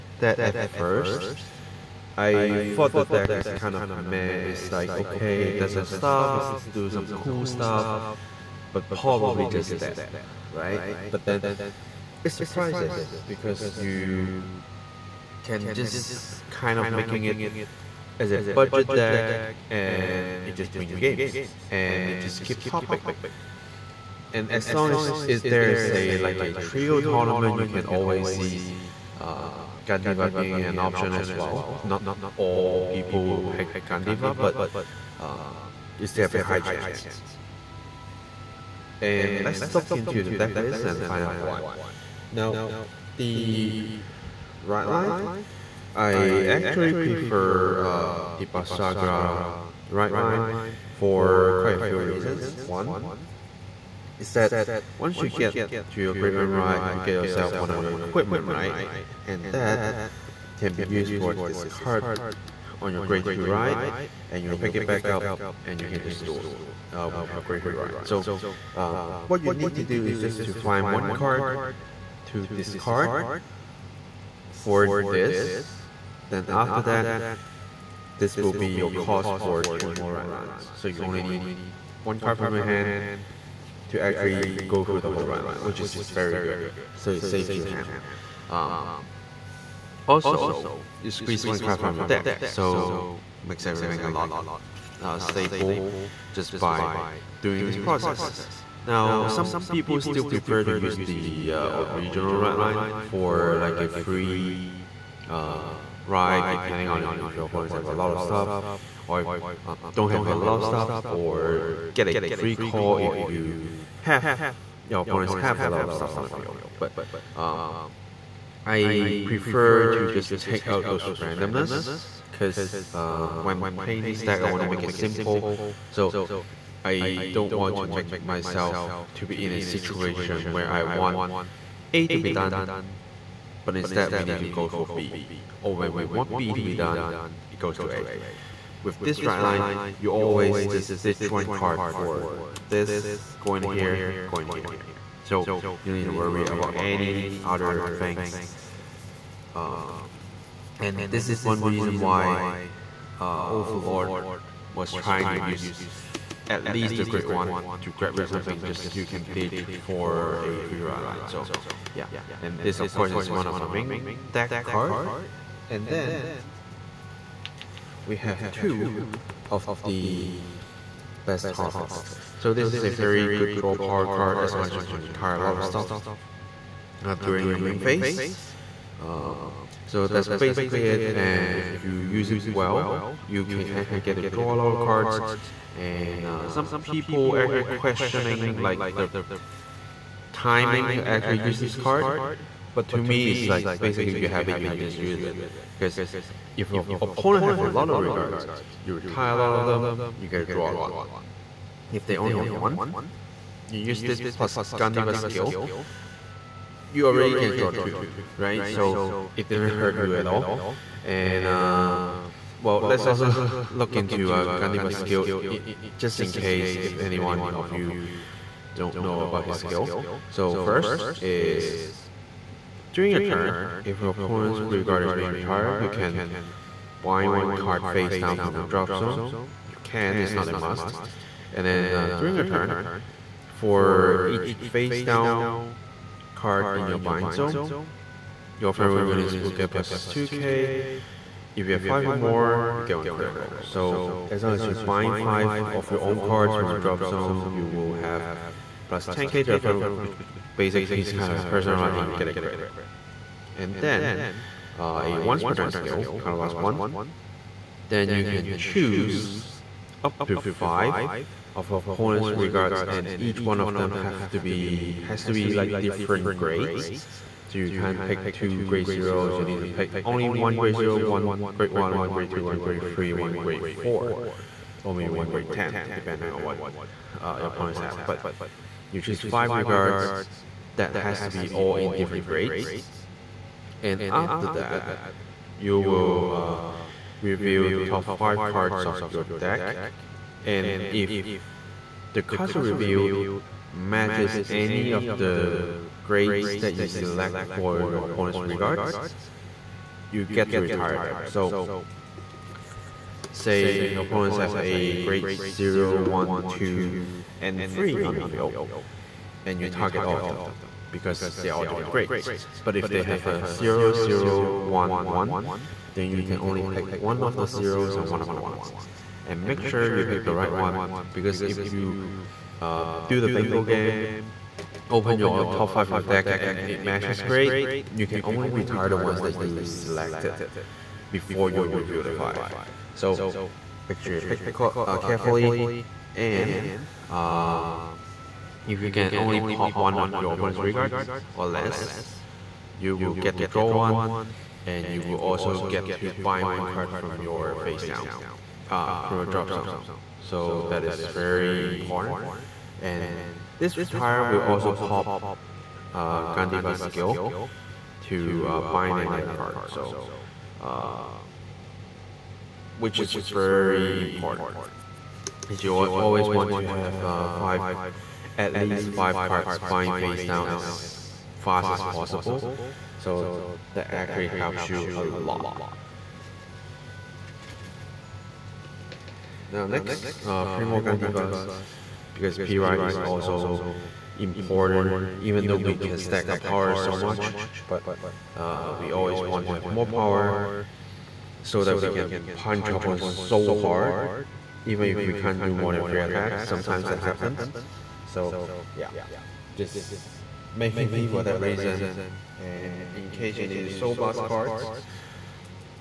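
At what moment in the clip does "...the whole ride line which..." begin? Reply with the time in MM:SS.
01:24.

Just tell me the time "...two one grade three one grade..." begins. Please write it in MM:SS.
04:32.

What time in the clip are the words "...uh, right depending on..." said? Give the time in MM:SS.
01:45.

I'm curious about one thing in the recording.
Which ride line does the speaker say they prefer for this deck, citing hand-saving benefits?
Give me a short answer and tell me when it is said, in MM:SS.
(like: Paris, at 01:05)
Basagra ride line, at 00:48.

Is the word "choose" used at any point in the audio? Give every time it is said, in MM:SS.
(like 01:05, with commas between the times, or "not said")
04:18, 04:38.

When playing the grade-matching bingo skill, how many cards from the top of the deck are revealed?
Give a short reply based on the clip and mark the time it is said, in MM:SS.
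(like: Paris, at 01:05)
5, at 04:47.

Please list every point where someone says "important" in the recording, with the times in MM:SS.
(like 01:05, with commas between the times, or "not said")
05:51, 06:04, 06:24.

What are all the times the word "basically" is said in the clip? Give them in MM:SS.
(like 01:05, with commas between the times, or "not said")
03:00, 03:13, 04:10.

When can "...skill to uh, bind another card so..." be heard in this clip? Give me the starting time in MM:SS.
05:56.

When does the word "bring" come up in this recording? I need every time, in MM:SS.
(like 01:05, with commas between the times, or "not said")
00:20.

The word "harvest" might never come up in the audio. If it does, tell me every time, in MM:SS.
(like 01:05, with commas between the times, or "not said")
02:51.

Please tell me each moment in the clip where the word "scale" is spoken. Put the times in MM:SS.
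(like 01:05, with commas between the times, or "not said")
04:15.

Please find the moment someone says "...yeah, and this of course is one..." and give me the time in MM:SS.
02:41.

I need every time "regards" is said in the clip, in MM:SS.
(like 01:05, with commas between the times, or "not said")
03:17, 04:22, 04:39, 04:58, 05:40.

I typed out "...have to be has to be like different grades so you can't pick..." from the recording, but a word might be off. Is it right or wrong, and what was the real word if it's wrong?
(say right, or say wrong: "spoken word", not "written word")
right.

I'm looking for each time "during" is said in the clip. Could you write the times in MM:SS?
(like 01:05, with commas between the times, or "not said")
02:57, 03:42, 03:52.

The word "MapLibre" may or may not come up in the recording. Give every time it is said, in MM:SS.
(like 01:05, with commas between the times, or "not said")
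not said.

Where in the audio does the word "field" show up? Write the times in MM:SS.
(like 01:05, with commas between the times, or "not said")
01:56, 05:08.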